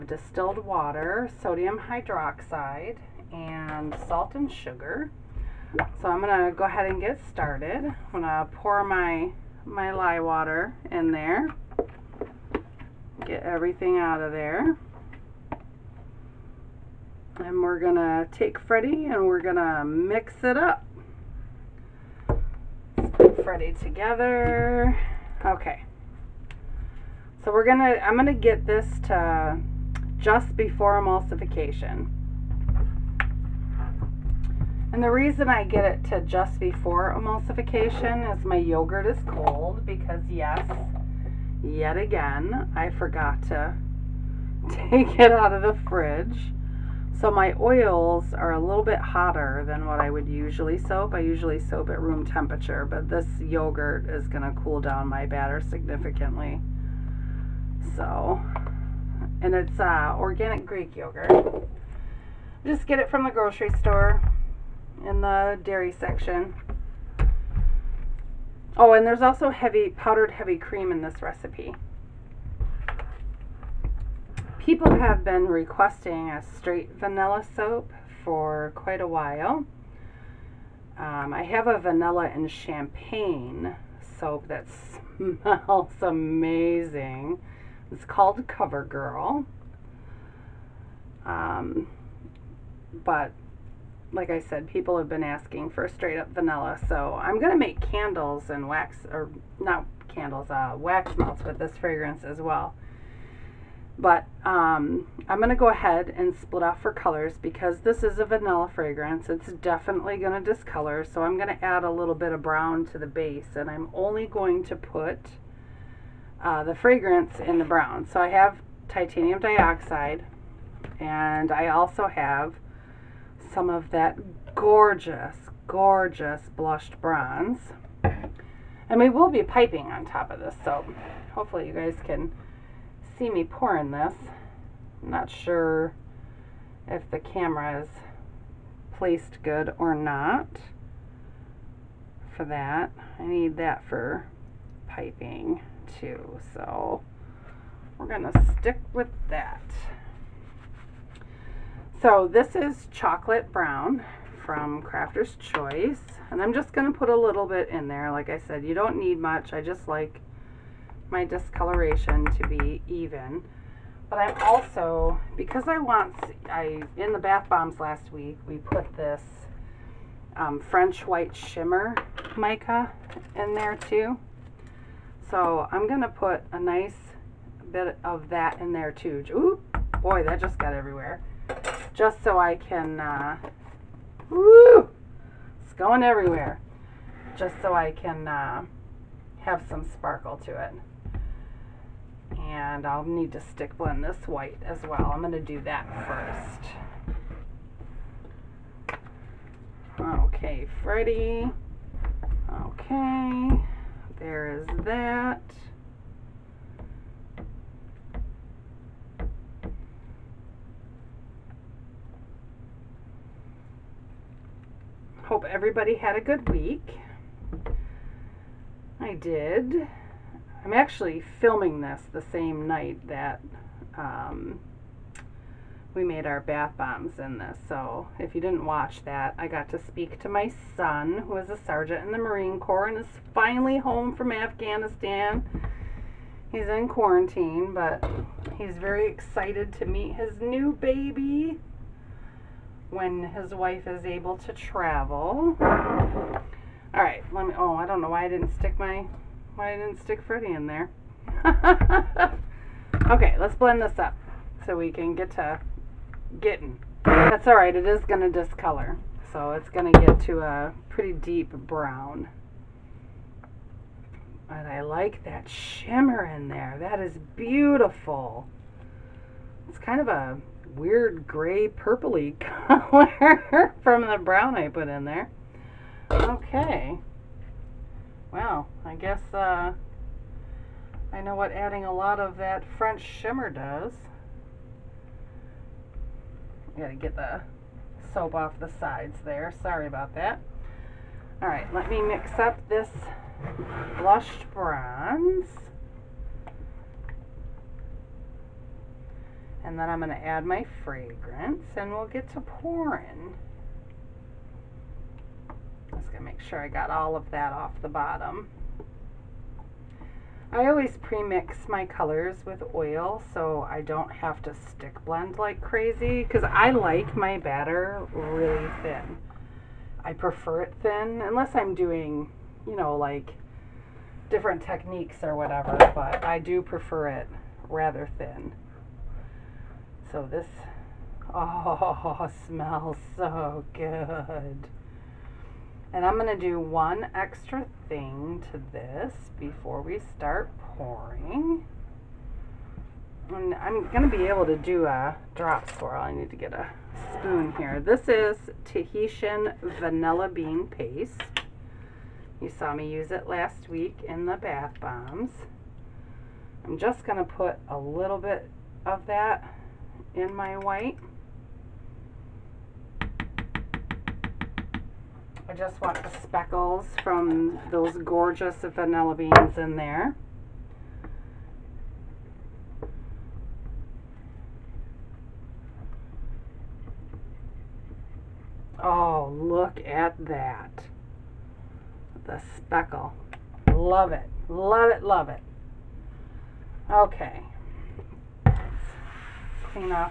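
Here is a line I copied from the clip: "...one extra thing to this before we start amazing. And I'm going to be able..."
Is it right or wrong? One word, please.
wrong.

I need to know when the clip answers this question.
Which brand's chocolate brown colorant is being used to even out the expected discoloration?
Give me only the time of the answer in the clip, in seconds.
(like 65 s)
154 s.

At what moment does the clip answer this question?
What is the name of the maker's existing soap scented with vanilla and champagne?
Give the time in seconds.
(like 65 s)
88 s.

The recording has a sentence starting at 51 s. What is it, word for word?
I usually soap at room temperature, but this yogurt is going to cool down my batter significantly.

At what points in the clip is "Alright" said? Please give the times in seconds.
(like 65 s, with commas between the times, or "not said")
291 s.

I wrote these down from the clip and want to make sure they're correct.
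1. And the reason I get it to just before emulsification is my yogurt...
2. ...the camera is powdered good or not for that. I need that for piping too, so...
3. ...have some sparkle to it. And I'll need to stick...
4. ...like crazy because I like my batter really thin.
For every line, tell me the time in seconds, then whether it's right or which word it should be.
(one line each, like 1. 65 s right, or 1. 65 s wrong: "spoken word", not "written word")
1. 34 s right
2. 137 s wrong: "placed", not "powdered"
3. 189 s right
4. 315 s right.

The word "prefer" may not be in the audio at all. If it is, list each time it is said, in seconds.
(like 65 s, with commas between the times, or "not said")
320 s, 326 s.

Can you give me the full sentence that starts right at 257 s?
That's all right, it is going to discolor.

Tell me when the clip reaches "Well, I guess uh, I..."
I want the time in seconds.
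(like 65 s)
278 s.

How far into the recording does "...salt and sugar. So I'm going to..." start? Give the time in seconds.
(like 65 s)
4 s.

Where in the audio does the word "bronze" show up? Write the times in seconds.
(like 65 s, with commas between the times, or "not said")
126 s, 294 s.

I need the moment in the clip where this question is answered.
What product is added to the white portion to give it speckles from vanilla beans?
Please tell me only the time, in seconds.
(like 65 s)
348 s.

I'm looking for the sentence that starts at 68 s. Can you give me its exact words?
Oh, and there's also heavy powdered heavy cream in this recipe.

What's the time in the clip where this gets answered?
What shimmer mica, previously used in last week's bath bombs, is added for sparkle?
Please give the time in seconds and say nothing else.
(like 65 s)
170 s.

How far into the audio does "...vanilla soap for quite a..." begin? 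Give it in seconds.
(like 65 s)
76 s.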